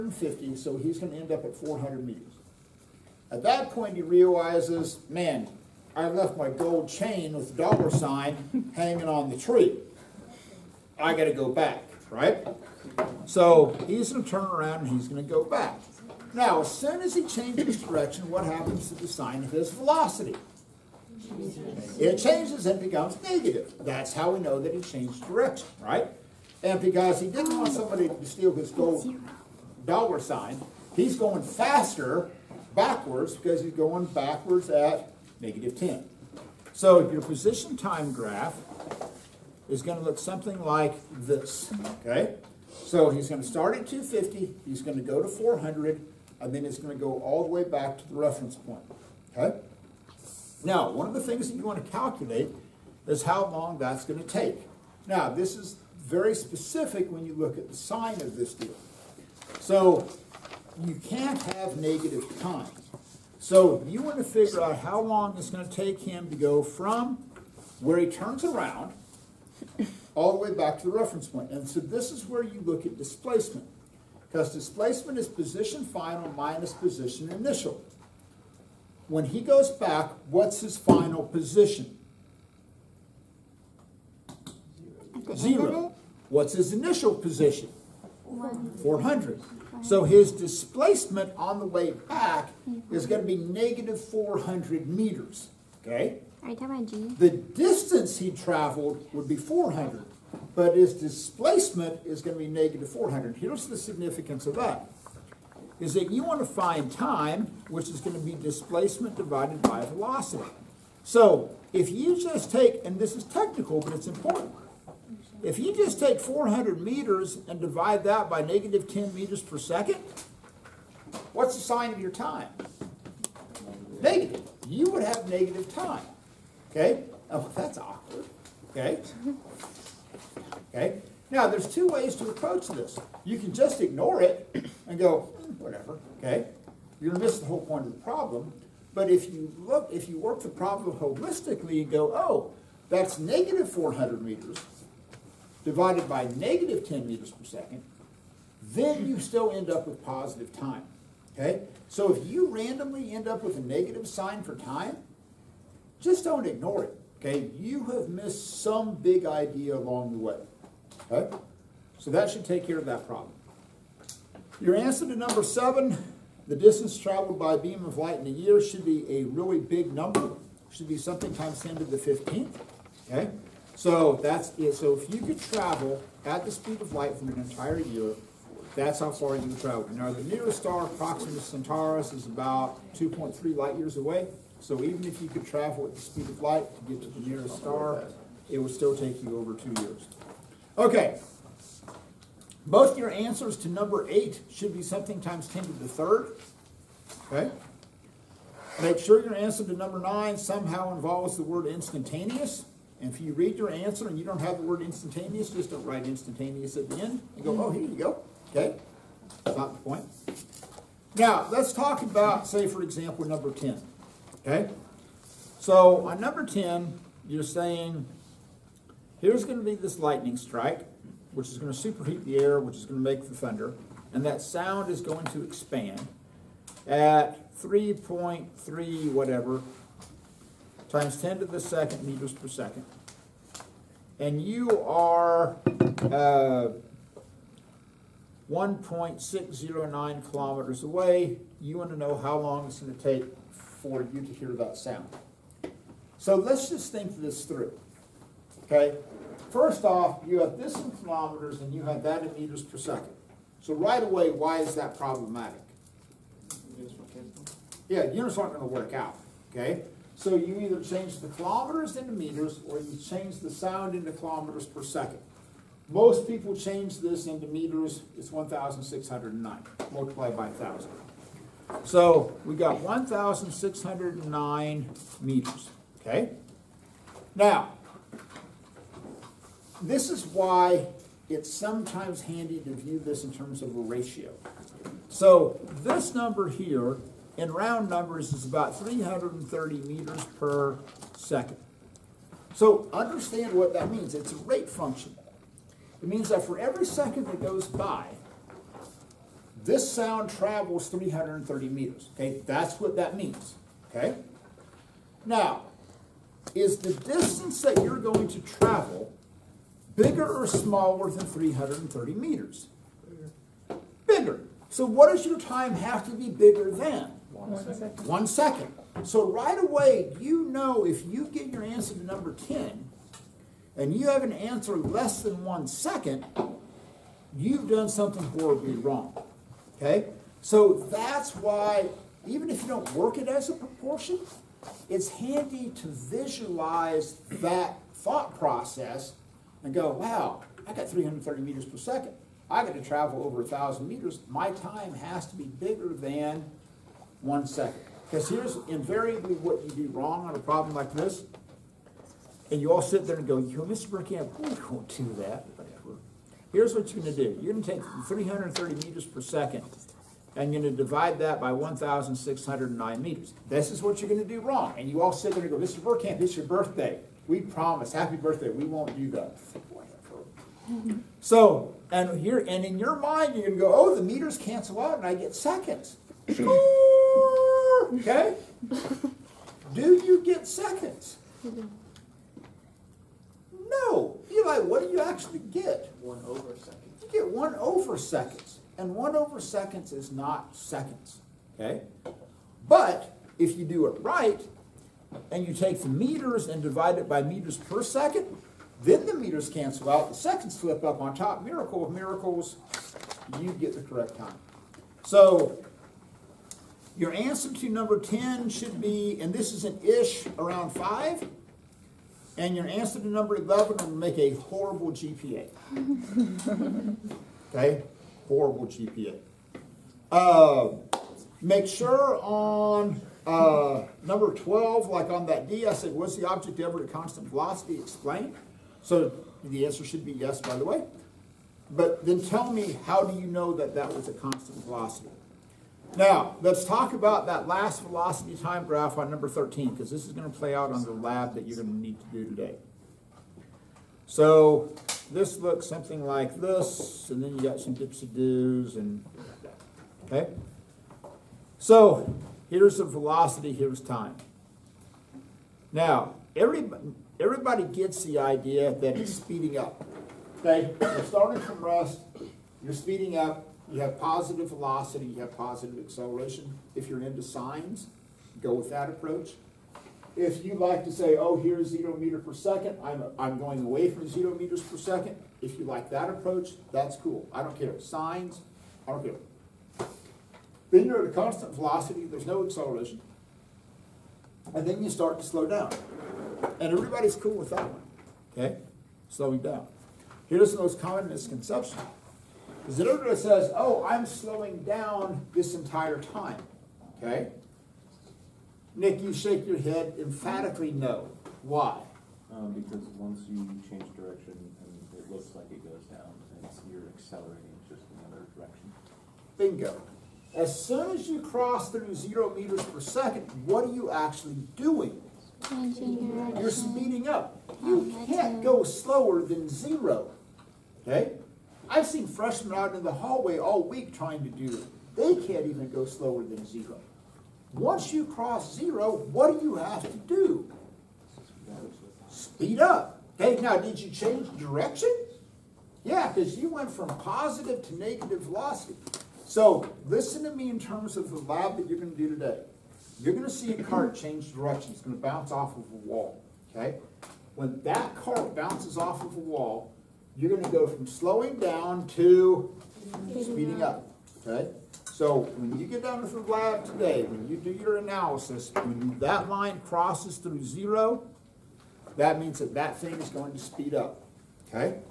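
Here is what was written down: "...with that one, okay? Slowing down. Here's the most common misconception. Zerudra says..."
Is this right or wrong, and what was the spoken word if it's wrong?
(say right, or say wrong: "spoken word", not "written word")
right.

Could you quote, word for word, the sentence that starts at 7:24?
So this looks something like this, and then you got some dips and doos, and okay?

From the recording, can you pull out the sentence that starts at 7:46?
If you're into signs, go with that approach.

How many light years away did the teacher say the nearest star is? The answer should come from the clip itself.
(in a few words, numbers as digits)
2.3.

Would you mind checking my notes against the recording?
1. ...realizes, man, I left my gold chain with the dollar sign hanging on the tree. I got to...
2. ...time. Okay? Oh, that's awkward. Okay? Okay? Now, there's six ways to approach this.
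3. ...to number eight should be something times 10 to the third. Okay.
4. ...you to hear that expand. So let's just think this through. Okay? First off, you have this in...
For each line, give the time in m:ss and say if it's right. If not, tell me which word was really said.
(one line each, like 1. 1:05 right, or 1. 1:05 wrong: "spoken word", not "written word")
1. 0:04 right
2. 2:05 wrong: "two", not "six"
3. 3:13 right
4. 4:04 wrong: "sound", not "expand".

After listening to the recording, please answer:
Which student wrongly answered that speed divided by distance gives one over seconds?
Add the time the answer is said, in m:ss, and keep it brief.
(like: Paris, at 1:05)
Eli, at 6:24.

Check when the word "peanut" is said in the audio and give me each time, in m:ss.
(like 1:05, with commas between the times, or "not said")
not said.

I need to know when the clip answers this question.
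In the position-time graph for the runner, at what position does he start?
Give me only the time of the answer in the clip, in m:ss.
0:43.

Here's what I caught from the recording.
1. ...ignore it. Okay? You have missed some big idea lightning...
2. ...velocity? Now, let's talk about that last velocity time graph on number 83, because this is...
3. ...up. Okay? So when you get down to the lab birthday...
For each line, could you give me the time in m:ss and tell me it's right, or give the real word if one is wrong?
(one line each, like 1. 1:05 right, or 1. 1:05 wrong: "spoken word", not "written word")
1. 2:36 wrong: "along", not "lightning"
2. 7:14 wrong: "13", not "83"
3. 9:13 wrong: "today", not "birthday".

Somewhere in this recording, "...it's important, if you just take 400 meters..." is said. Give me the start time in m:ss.
1:53.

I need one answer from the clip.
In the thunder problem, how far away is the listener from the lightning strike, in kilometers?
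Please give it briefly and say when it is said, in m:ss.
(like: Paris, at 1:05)
1.609 kilometers, at 3:58.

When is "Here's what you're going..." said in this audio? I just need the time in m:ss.
5:56.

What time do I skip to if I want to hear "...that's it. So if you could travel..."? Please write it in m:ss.
2:54.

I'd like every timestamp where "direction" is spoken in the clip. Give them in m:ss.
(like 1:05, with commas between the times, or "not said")
0:17, 0:25, 8:23, 8:28, 8:36, 8:54, 9:04.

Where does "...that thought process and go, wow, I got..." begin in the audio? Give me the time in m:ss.
5:37.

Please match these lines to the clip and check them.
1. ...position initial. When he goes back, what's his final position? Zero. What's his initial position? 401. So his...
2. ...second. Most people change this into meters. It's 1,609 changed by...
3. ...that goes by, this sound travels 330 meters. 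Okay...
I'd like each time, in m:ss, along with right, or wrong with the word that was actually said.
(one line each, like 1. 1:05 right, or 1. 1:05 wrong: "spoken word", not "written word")
1. 1:16 wrong: "400", not "401"
2. 4:24 wrong: "multiplied", not "changed"
3. 4:57 right.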